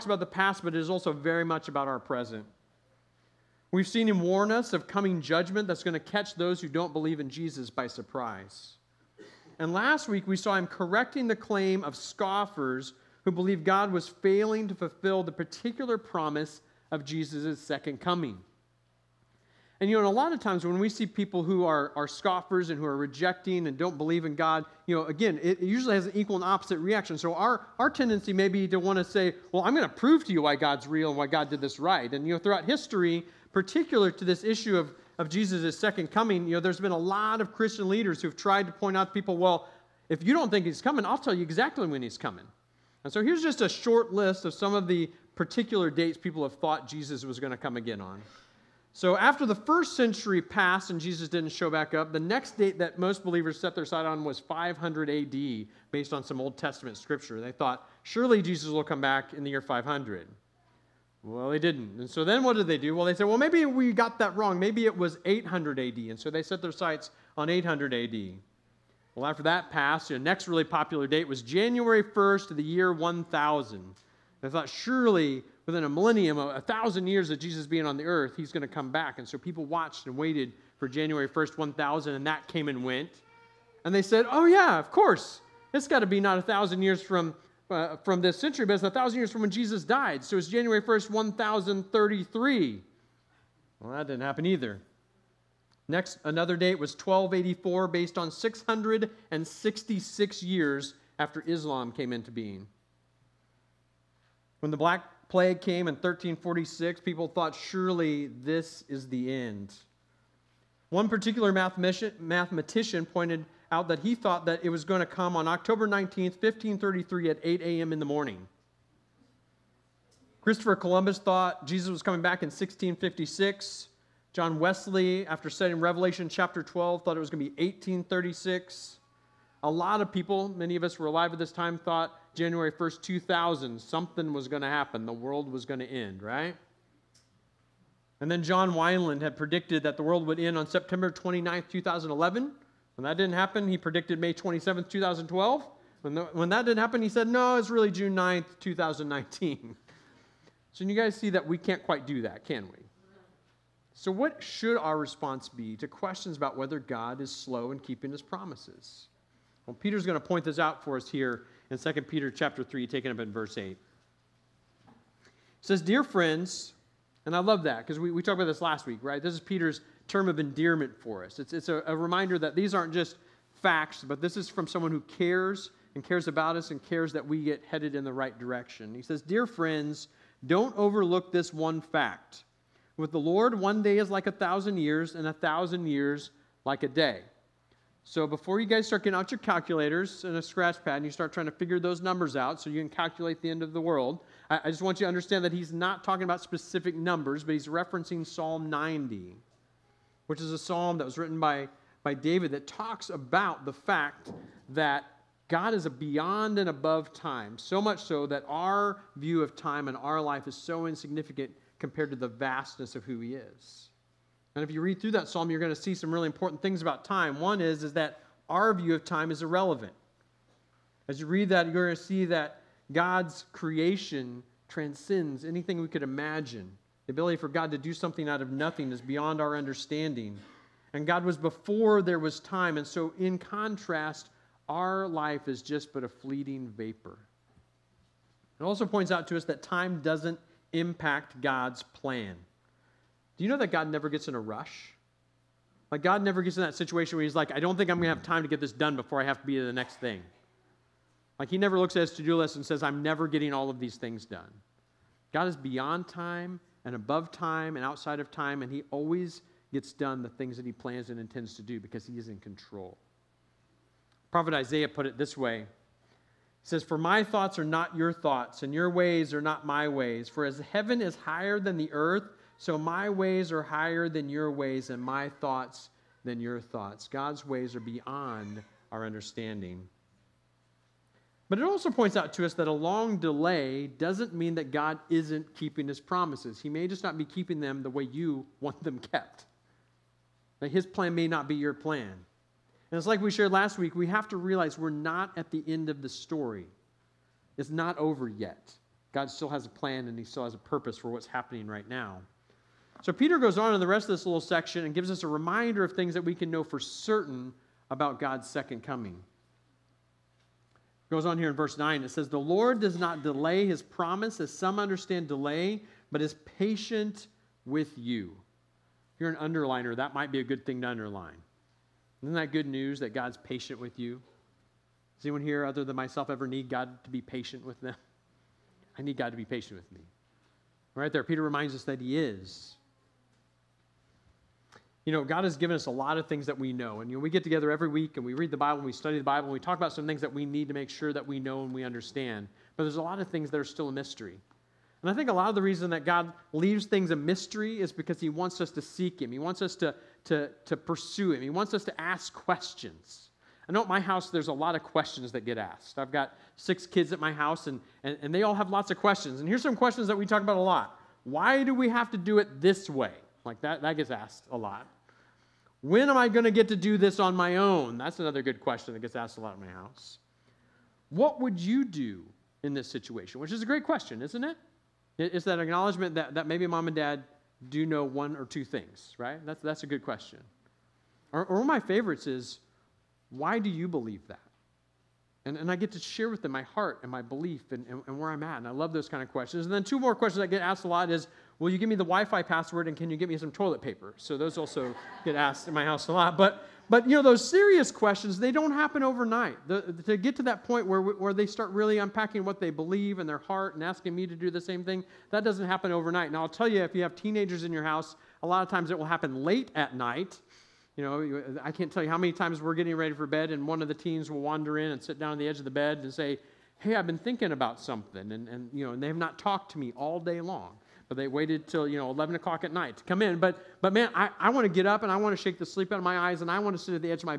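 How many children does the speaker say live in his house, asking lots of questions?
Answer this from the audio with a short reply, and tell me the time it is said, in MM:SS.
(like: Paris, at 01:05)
6, at 05:56.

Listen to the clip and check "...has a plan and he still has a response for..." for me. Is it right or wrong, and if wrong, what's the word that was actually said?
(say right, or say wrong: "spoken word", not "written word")
wrong: "purpose", not "response".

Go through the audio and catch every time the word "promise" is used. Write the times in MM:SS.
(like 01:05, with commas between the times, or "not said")
00:15, 02:38, 04:46, 05:13.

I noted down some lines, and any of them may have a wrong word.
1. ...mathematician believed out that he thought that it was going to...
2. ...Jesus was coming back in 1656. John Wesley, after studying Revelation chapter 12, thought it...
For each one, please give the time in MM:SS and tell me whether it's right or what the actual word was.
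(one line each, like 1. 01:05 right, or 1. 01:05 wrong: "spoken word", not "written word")
1. 01:51 wrong: "pointed", not "believed"
2. 02:01 right.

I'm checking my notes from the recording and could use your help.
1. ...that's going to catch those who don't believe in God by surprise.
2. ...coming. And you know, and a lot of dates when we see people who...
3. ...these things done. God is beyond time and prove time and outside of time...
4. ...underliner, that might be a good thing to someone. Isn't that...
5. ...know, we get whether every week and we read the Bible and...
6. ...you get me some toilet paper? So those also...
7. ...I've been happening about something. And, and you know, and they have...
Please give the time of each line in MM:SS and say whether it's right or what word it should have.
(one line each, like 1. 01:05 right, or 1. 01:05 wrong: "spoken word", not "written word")
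1. 00:05 wrong: "Jesus", not "God"
2. 00:18 wrong: "times", not "dates"
3. 04:13 wrong: "above", not "prove"
4. 05:19 wrong: "underline", not "someone"
5. 05:37 wrong: "together", not "whether"
6. 06:33 right
7. 06:56 wrong: "thinking", not "happening".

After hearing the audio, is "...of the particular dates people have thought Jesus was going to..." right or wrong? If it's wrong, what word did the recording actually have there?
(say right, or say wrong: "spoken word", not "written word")
right.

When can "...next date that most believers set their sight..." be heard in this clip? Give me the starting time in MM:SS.
00:52.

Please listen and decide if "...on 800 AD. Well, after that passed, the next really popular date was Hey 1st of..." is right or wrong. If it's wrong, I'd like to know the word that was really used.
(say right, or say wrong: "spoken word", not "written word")
wrong: "January", not "Hey".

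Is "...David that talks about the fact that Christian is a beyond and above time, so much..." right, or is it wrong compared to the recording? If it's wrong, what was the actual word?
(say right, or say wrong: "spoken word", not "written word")
wrong: "God", not "Christian".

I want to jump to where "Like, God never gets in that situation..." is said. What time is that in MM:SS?
04:05.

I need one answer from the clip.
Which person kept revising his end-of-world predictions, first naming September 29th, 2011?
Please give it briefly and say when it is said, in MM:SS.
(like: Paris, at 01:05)
John Weinland, at 02:18.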